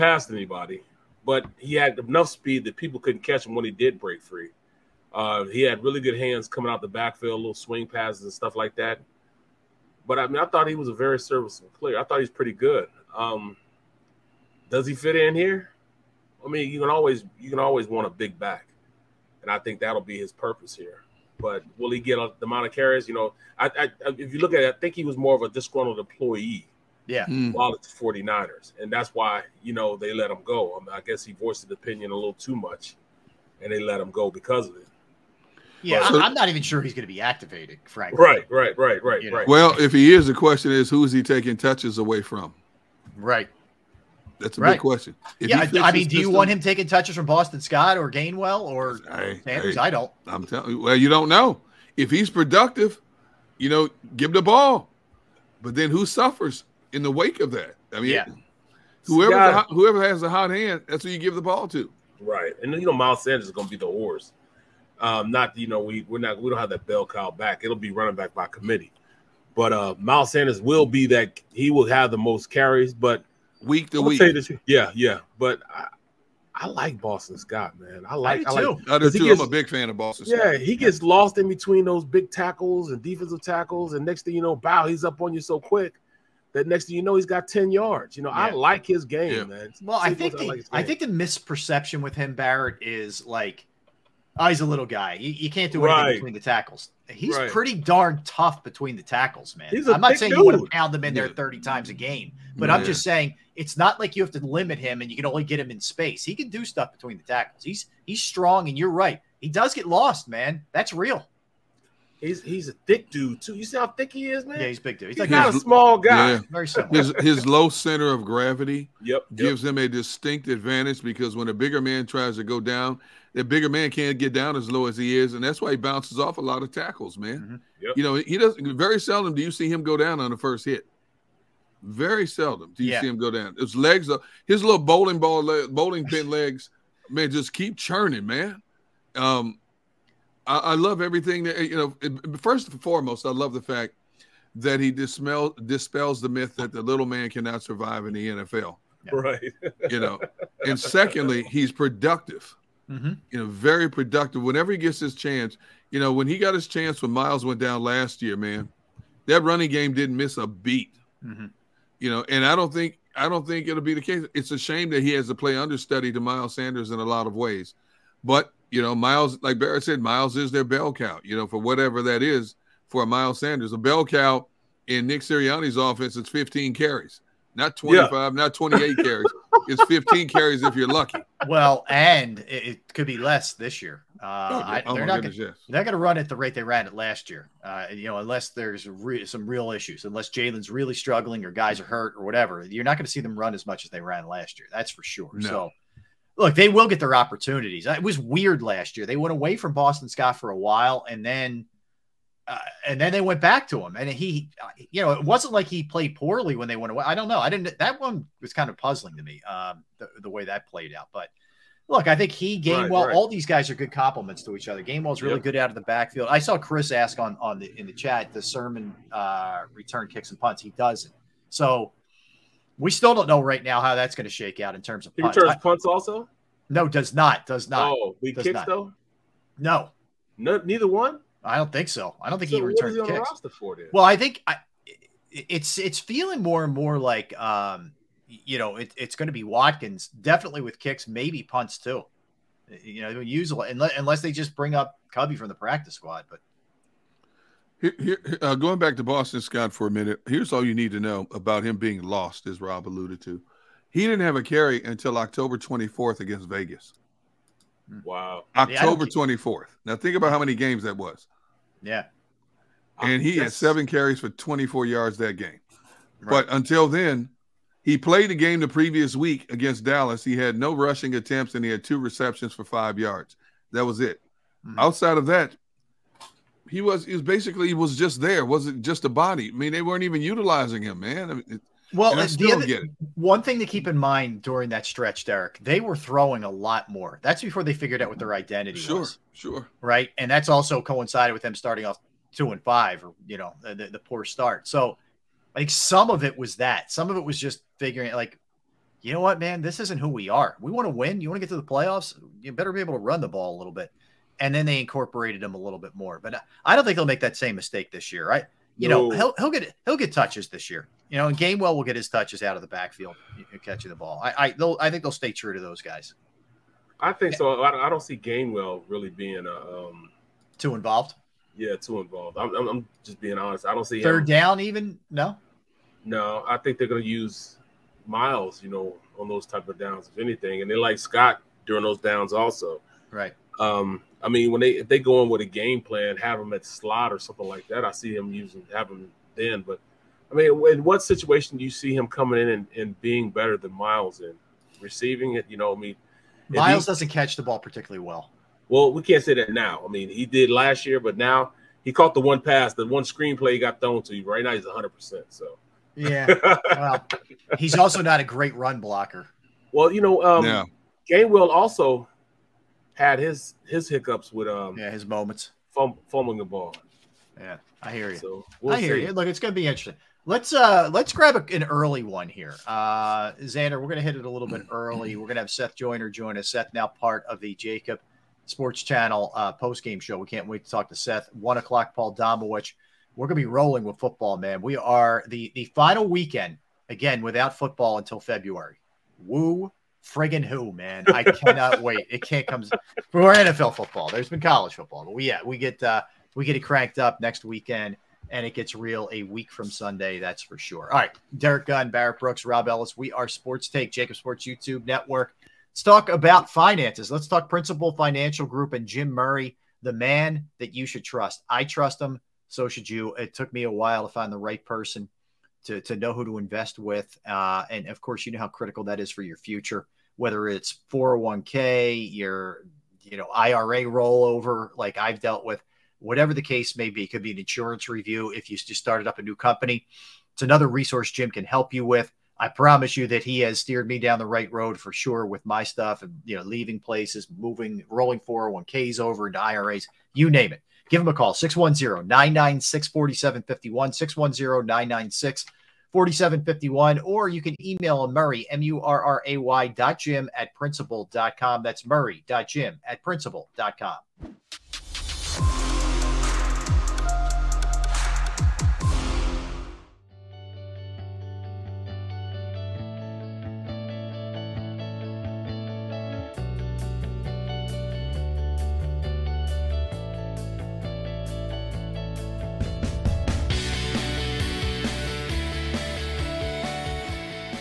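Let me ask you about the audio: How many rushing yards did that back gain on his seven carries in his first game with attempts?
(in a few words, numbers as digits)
24.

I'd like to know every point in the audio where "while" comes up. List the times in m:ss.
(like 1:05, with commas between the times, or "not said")
0:27, 3:20, 6:53.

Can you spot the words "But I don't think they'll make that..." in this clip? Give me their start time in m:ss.
5:06.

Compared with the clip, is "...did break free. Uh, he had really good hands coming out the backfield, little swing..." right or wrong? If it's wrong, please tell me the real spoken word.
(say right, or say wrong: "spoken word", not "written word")
right.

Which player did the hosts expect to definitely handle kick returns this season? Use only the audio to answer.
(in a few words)
Watkins.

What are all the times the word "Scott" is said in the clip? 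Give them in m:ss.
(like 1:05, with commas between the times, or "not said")
0:47, 1:17, 3:20, 4:09, 5:30.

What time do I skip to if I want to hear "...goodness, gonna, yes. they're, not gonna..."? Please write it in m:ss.
3:05.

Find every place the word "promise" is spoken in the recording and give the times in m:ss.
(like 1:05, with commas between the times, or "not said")
7:12.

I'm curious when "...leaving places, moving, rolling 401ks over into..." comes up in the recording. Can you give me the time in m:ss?
7:16.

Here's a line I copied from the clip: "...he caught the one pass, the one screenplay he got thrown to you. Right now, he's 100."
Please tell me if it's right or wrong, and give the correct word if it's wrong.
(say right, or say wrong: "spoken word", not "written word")
right.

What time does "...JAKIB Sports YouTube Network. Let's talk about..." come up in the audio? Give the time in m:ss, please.
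6:43.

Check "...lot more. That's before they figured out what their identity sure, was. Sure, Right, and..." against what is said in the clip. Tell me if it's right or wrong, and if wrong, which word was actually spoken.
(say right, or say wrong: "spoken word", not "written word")
right.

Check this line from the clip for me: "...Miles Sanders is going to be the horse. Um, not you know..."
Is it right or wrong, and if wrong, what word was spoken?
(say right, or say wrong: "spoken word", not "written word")
right.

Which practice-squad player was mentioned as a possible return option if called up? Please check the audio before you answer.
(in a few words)
Covey.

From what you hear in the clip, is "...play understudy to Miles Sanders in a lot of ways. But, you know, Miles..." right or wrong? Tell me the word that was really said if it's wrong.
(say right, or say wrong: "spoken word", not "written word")
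right.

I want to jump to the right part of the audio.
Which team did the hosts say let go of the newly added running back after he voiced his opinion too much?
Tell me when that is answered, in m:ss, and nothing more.
0:27.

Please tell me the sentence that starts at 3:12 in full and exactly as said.
You're not going to see them run as much as they ran last year.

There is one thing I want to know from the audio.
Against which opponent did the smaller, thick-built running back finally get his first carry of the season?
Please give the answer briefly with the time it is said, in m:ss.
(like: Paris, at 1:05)
Vegas, at 4:16.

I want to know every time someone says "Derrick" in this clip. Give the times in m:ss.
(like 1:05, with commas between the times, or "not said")
4:45, 6:41.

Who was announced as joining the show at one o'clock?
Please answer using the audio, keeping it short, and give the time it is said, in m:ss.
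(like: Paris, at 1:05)
Paul Domowitch, at 6:21.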